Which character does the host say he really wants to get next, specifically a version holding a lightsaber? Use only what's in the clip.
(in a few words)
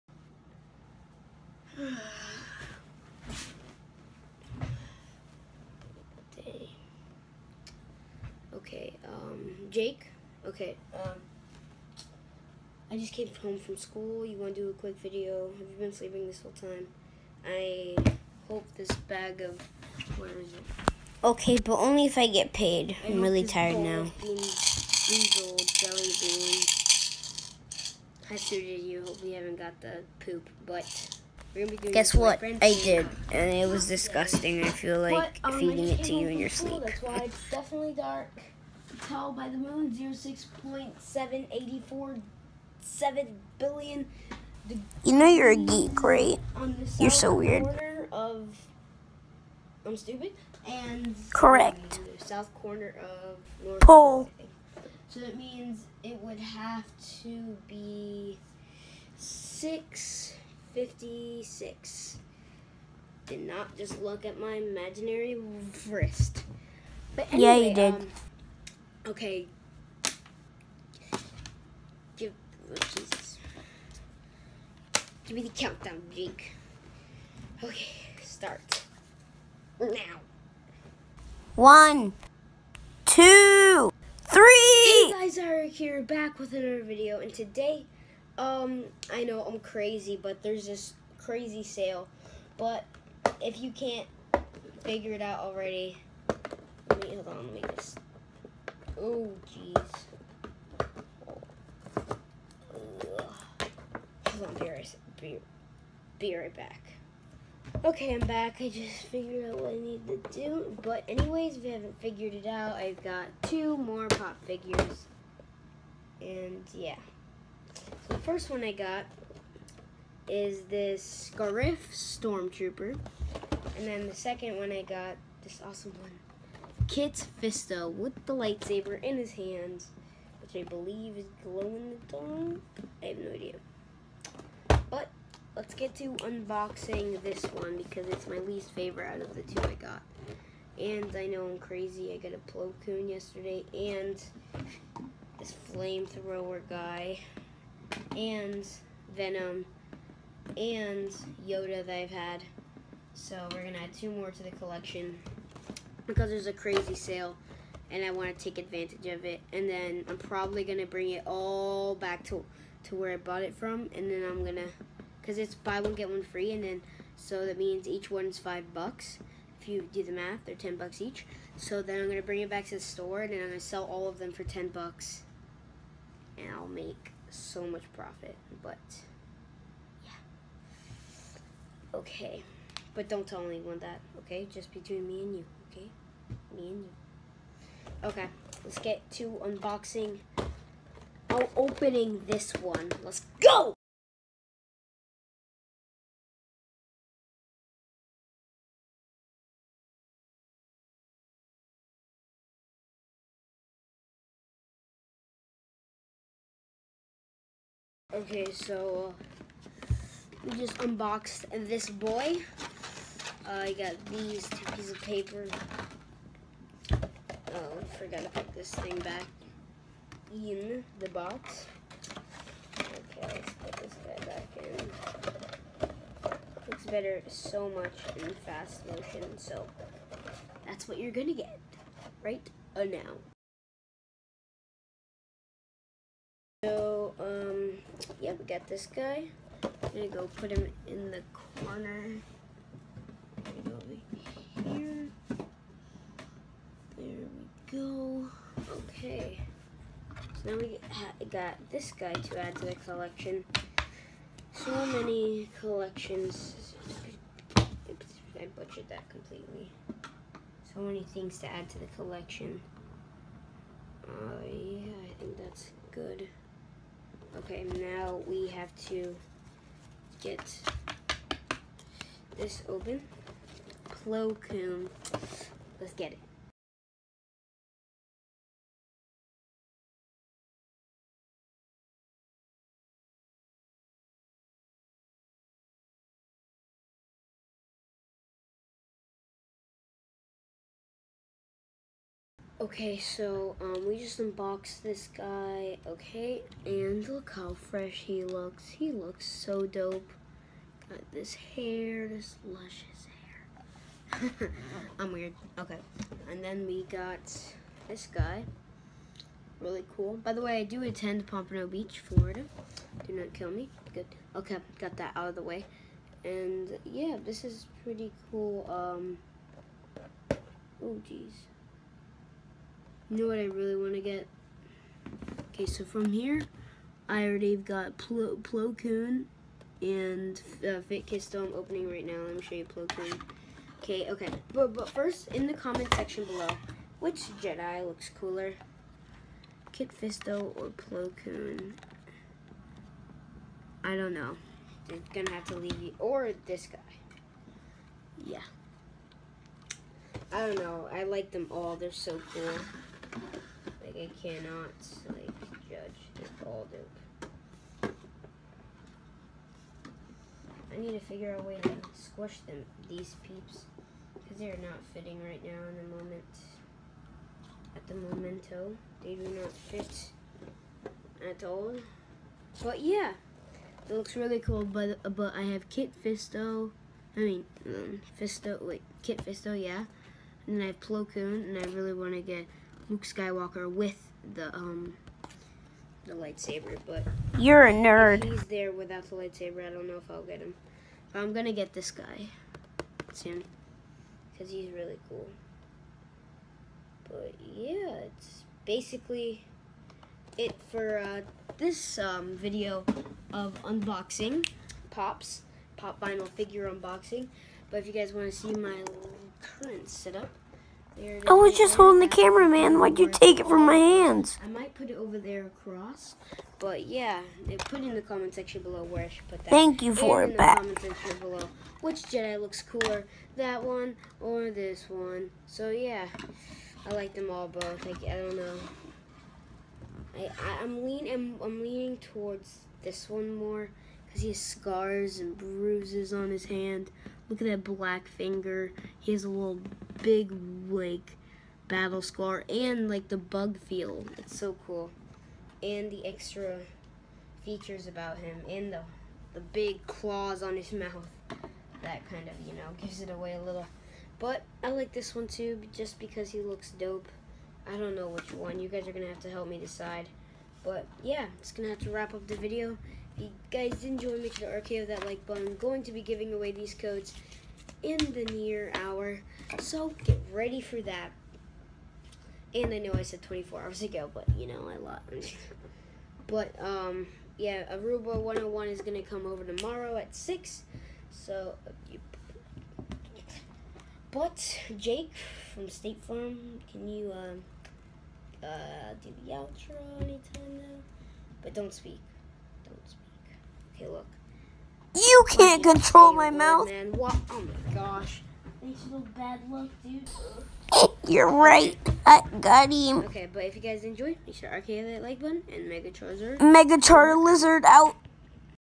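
Luke Skywalker.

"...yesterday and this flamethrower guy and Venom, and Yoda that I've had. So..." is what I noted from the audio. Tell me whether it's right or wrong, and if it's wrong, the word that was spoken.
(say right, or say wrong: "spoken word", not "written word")
right.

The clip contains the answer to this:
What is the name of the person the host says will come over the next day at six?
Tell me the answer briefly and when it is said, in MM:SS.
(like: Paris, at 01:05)
Aruba 101, at 07:57.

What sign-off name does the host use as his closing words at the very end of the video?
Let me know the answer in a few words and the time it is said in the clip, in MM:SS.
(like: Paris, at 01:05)
Mega Charizard, at 08:26.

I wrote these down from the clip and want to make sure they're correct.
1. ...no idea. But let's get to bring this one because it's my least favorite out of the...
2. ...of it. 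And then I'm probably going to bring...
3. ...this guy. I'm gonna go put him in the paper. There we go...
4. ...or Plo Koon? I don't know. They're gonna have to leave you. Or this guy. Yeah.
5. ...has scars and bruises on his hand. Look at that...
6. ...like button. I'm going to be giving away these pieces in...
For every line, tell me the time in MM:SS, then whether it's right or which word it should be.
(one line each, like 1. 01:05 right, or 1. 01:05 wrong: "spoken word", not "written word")
1. 02:13 wrong: "unboxing", not "bring"
2. 02:39 right
3. 03:58 wrong: "corner", not "paper"
4. 05:40 right
5. 07:14 right
6. 07:45 wrong: "codes", not "pieces".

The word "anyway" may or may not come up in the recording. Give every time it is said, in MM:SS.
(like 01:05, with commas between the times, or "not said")
01:07, 01:51.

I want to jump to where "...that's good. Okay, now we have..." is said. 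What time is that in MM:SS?
04:25.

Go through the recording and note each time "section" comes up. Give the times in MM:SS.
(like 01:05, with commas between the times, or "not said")
05:35, 06:58.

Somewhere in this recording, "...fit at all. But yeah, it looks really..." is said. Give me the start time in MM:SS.
06:09.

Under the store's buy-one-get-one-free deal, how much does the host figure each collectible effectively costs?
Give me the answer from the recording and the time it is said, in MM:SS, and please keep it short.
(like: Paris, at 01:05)
5 bucks, at 02:48.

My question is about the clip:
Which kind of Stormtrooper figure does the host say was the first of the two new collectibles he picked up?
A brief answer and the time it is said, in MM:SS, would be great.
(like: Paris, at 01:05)
Scarif Stormtrooper, at 02:01.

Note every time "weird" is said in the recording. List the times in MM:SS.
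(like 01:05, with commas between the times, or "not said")
00:47, 05:05.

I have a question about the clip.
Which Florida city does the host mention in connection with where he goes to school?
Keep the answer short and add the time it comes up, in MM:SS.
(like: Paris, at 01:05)
Pompano Beach, at 05:11.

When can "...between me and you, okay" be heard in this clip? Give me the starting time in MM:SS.
03:04.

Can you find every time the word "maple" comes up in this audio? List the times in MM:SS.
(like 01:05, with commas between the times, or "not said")
not said.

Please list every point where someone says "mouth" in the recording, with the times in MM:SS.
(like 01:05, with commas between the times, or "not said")
07:30, 08:16.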